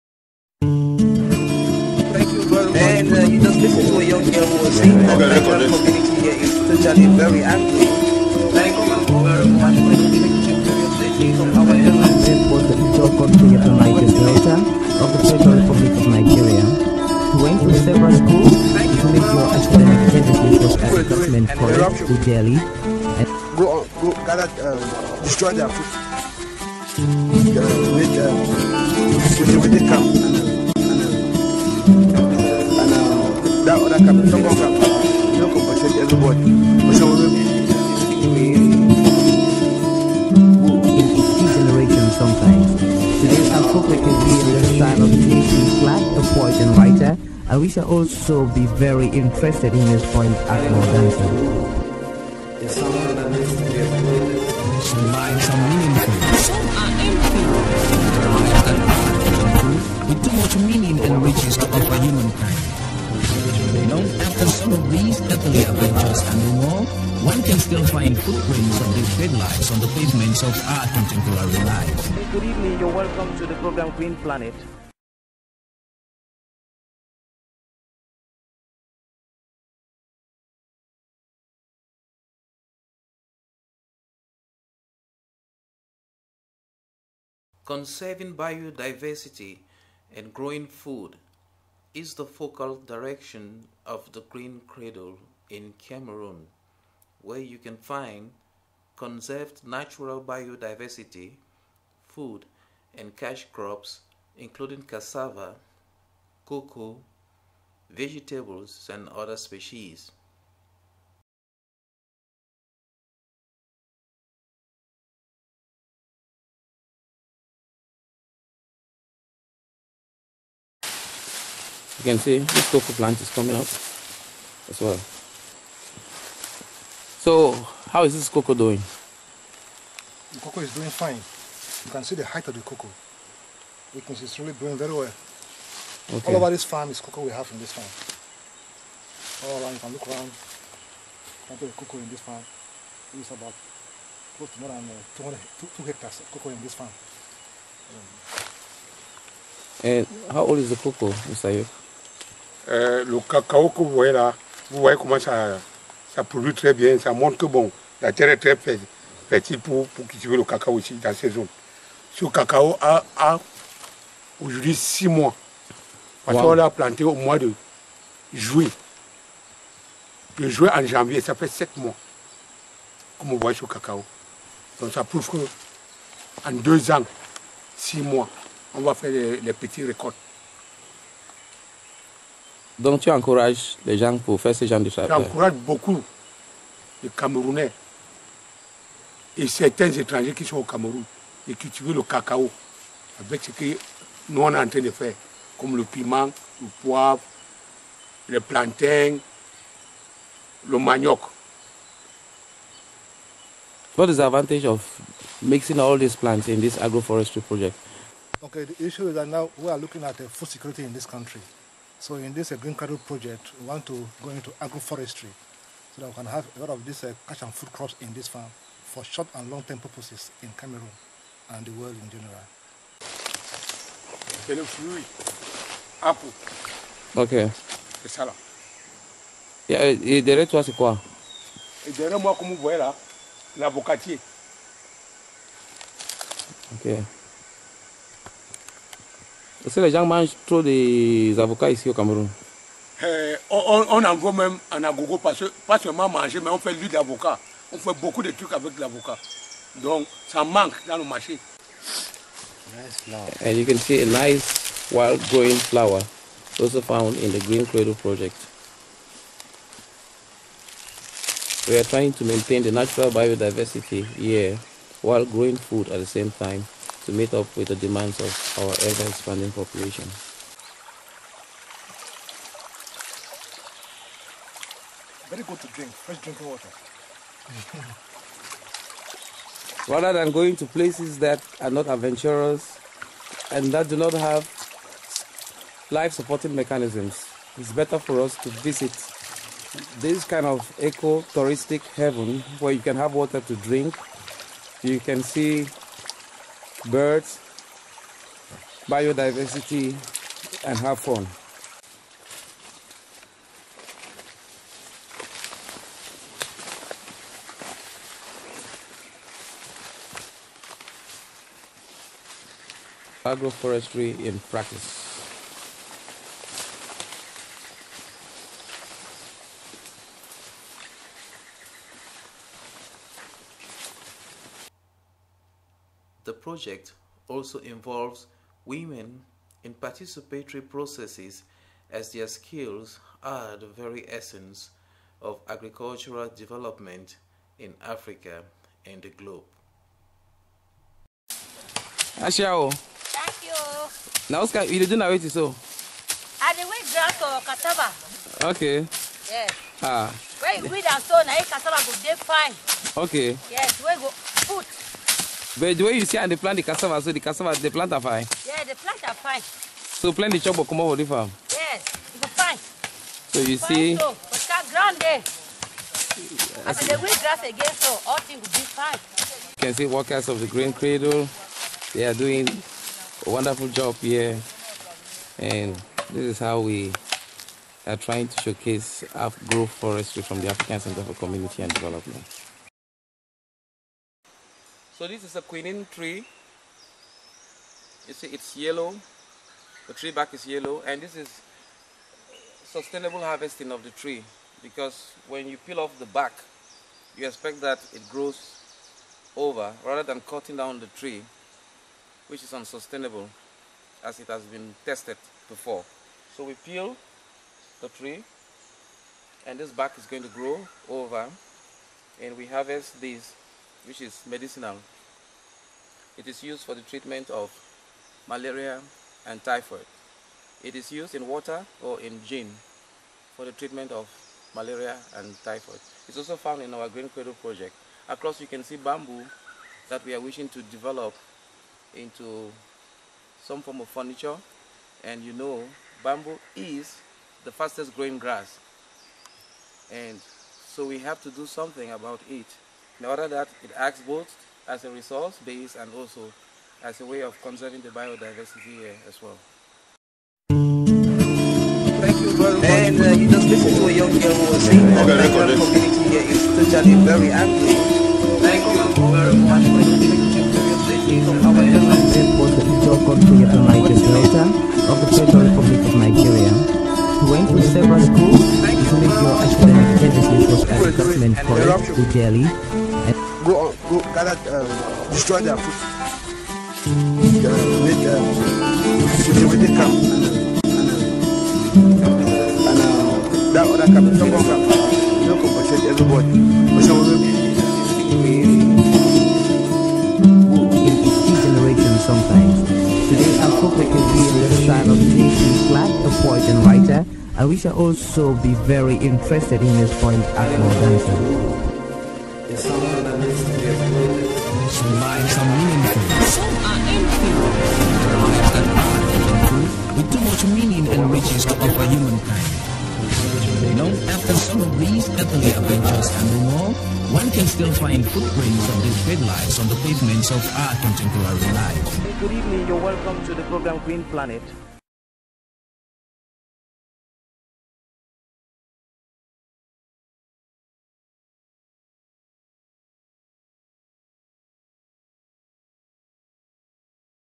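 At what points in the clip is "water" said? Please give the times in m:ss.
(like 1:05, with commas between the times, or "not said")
4:36, 4:53, 7:01.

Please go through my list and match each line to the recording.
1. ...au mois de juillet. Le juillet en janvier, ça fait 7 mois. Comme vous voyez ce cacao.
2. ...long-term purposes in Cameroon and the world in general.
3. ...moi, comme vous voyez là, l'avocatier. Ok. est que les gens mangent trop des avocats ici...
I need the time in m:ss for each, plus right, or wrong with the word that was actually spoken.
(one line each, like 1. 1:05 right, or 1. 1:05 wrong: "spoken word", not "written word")
1. 2:47 right
2. 3:39 right
3. 3:52 right.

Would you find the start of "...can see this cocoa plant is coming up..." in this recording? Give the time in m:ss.
2:02.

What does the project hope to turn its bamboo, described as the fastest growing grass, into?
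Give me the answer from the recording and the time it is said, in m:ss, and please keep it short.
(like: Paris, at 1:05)
Furniture, at 7:13.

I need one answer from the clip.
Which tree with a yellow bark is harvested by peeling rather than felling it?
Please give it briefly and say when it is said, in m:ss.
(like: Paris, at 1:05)
Quinine tree, at 6:25.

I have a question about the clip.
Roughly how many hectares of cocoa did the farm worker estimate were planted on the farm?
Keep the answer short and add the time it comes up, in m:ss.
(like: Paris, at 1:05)
200, at 2:25.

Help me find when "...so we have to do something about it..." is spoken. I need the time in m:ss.
7:20.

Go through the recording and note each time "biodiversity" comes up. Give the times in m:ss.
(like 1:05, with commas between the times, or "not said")
1:28, 1:40, 4:23, 4:58, 7:27.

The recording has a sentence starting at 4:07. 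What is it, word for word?
On fait beaucoup de trucs avec l'avocat.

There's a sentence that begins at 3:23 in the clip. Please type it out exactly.
What is the advantage of mixing all these plants in this agroforestry project?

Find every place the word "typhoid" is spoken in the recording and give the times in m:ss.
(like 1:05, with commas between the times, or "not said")
6:59, 7:05.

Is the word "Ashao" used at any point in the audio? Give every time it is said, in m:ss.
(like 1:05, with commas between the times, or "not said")
5:42.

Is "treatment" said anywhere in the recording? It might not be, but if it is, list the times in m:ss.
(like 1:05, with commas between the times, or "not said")
6:56, 7:03.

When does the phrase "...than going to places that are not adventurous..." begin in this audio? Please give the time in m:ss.
4:40.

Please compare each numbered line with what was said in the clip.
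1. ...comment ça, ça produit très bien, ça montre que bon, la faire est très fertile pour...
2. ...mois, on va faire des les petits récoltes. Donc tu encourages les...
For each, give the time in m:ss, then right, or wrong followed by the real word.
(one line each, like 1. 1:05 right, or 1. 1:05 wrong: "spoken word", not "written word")
1. 2:34 wrong: "terre", not "faire"
2. 2:58 right.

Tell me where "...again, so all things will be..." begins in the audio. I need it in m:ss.
6:07.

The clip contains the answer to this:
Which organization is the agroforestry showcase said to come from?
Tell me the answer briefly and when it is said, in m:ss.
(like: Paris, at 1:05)
African Center for Community and Development, at 6:20.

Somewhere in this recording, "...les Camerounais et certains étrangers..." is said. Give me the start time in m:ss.
3:07.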